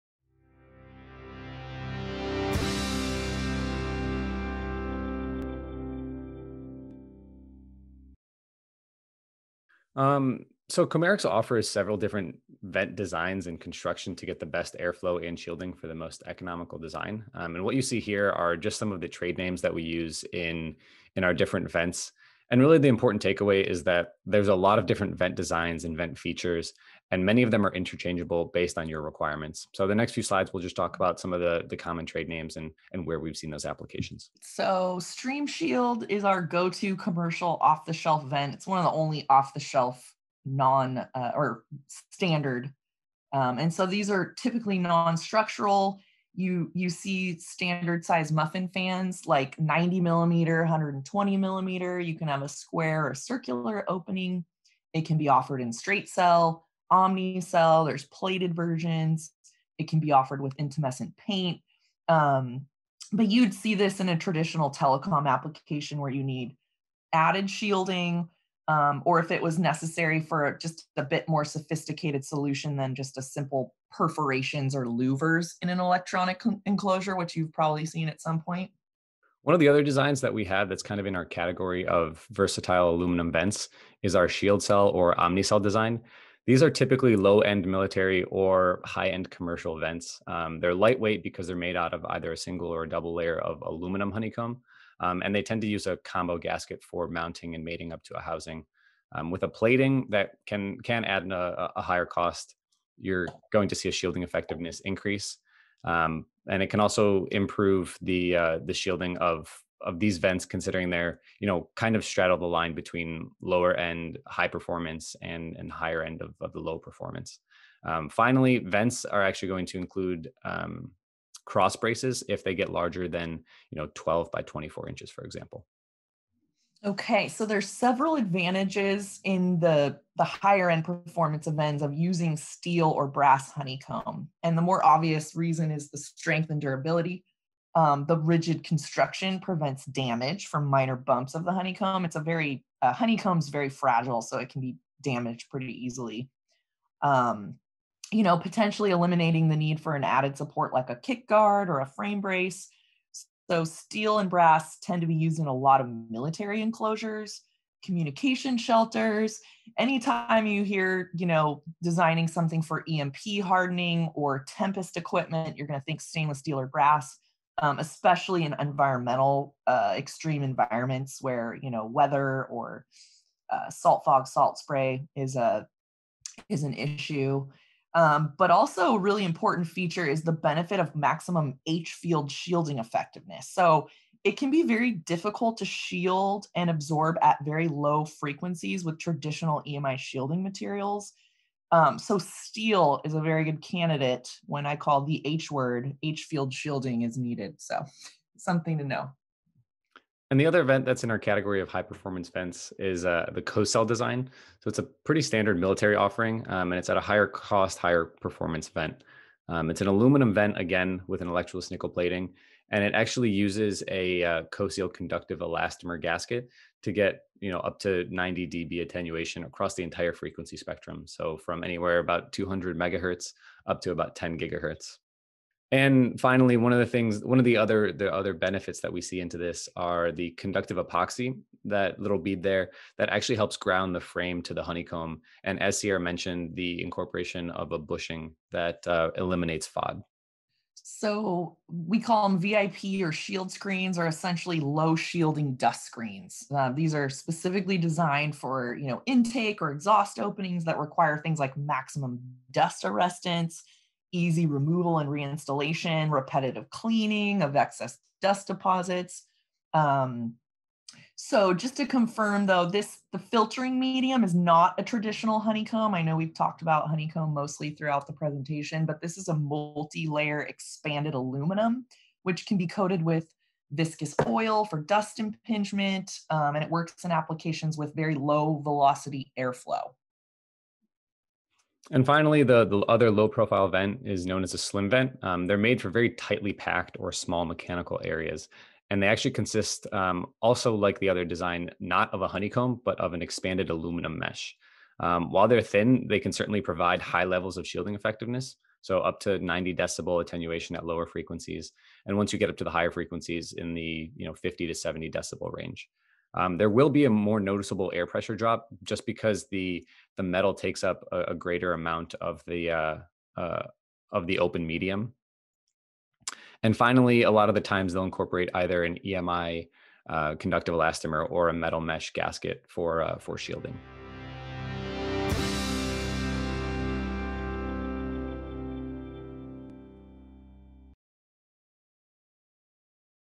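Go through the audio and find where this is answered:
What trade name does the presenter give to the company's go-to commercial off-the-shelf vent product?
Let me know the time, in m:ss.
0:34.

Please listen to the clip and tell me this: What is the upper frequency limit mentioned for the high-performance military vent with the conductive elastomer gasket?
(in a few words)
10 gigahertz.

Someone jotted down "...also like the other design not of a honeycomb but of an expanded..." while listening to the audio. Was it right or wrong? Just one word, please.
right.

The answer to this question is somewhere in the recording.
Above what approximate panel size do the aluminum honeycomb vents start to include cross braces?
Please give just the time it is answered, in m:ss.
2:03.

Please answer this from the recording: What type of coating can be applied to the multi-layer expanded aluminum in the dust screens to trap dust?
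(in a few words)
viscous oil.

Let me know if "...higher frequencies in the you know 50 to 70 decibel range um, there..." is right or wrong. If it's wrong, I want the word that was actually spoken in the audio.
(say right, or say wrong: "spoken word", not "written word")
right.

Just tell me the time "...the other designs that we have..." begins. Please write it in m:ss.
1:19.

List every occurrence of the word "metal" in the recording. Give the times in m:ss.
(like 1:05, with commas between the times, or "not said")
5:10, 5:21.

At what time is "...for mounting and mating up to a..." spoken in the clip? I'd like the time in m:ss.
1:36.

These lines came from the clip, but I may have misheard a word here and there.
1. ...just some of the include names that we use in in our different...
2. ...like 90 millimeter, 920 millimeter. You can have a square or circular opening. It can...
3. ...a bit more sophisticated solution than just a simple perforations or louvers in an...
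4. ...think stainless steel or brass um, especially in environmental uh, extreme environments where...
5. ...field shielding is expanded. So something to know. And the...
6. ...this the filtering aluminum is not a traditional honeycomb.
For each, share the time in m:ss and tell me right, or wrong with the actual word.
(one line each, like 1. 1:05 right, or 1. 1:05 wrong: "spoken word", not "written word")
1. 0:18 wrong: "trade", not "include"
2. 0:49 wrong: "120", not "920"
3. 1:10 right
4. 2:45 right
5. 3:16 wrong: "needed", not "expanded"
6. 4:22 wrong: "medium", not "aluminum".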